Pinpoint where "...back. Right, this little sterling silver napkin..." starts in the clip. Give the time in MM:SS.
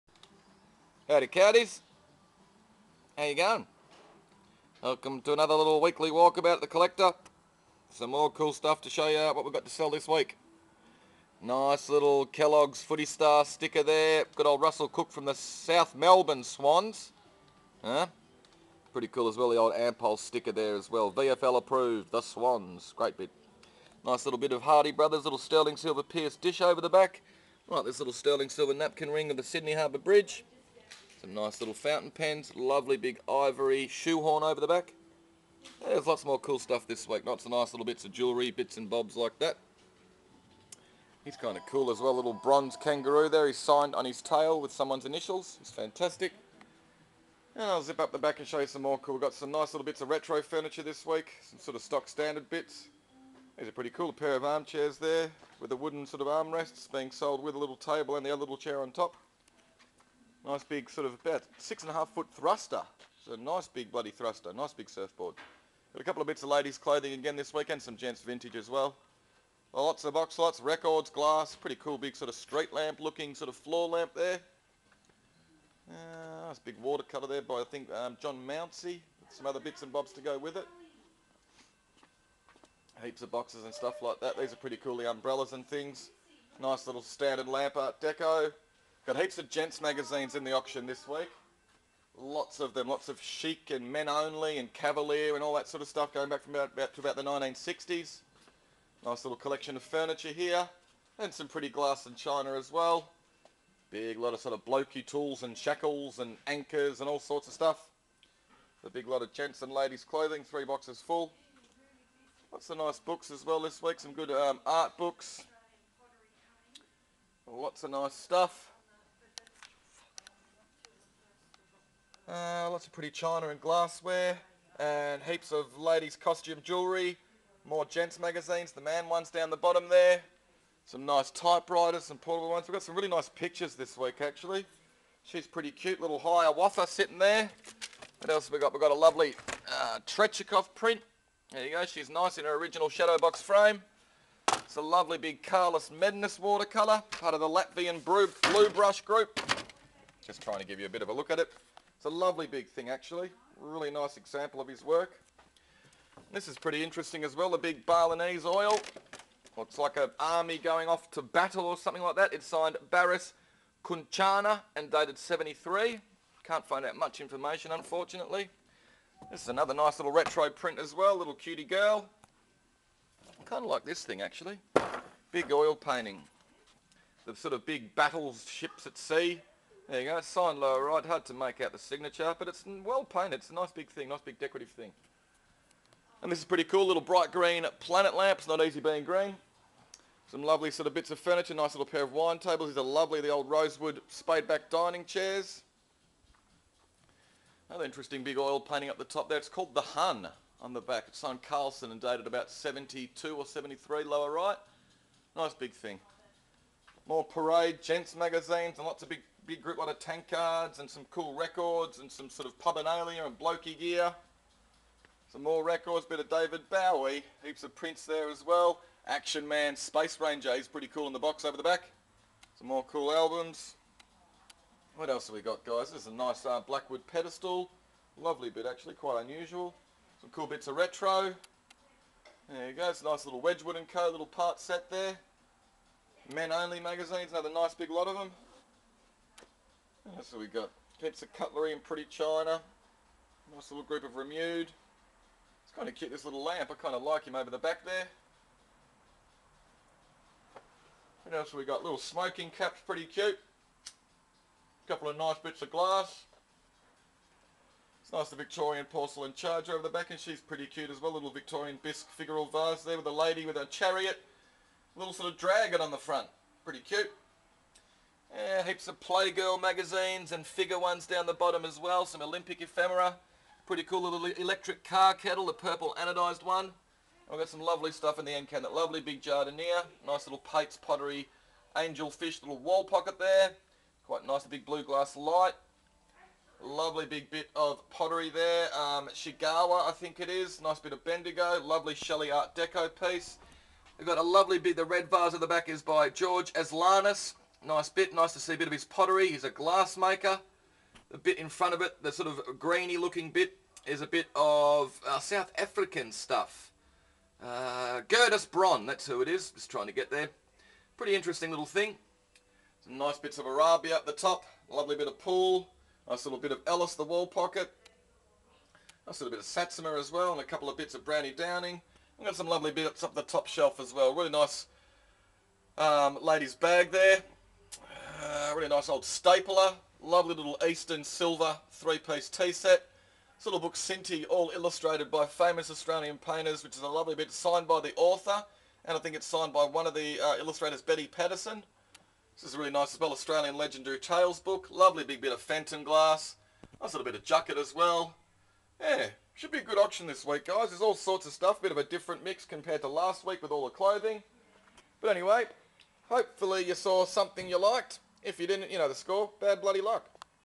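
00:26.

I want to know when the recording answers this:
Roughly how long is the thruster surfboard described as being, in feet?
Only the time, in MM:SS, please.
01:01.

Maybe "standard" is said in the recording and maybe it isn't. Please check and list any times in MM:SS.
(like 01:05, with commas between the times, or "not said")
00:52, 01:27.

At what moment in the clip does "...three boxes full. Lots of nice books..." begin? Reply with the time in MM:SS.
01:50.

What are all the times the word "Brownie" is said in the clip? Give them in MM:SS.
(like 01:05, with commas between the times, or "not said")
05:21.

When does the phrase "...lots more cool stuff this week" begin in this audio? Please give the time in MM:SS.
00:36.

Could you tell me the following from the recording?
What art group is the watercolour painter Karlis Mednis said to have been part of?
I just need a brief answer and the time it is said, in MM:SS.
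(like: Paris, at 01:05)
Latvian Blue Brush Group, at 02:27.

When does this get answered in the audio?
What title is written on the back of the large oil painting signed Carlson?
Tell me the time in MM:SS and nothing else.
03:19.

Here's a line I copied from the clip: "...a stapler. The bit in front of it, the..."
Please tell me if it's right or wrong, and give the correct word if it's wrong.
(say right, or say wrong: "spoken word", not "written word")
wrong: "glassmaker", not "stapler".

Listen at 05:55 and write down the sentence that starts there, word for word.
But anyway, hopefully you saw something you liked.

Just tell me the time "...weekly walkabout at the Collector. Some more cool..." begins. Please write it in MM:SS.
00:05.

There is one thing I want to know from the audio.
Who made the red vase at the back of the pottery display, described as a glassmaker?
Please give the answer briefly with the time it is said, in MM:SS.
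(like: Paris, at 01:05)
George Aslanis, at 04:56.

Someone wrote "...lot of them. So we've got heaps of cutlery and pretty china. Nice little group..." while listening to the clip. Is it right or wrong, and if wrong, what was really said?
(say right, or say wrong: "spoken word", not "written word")
right.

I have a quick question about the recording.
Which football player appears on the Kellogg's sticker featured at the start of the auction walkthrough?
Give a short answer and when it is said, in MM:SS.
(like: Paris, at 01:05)
Russell Cook, at 00:14.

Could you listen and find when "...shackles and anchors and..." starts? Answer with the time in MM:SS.
01:45.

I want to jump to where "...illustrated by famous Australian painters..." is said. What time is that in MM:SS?
05:34.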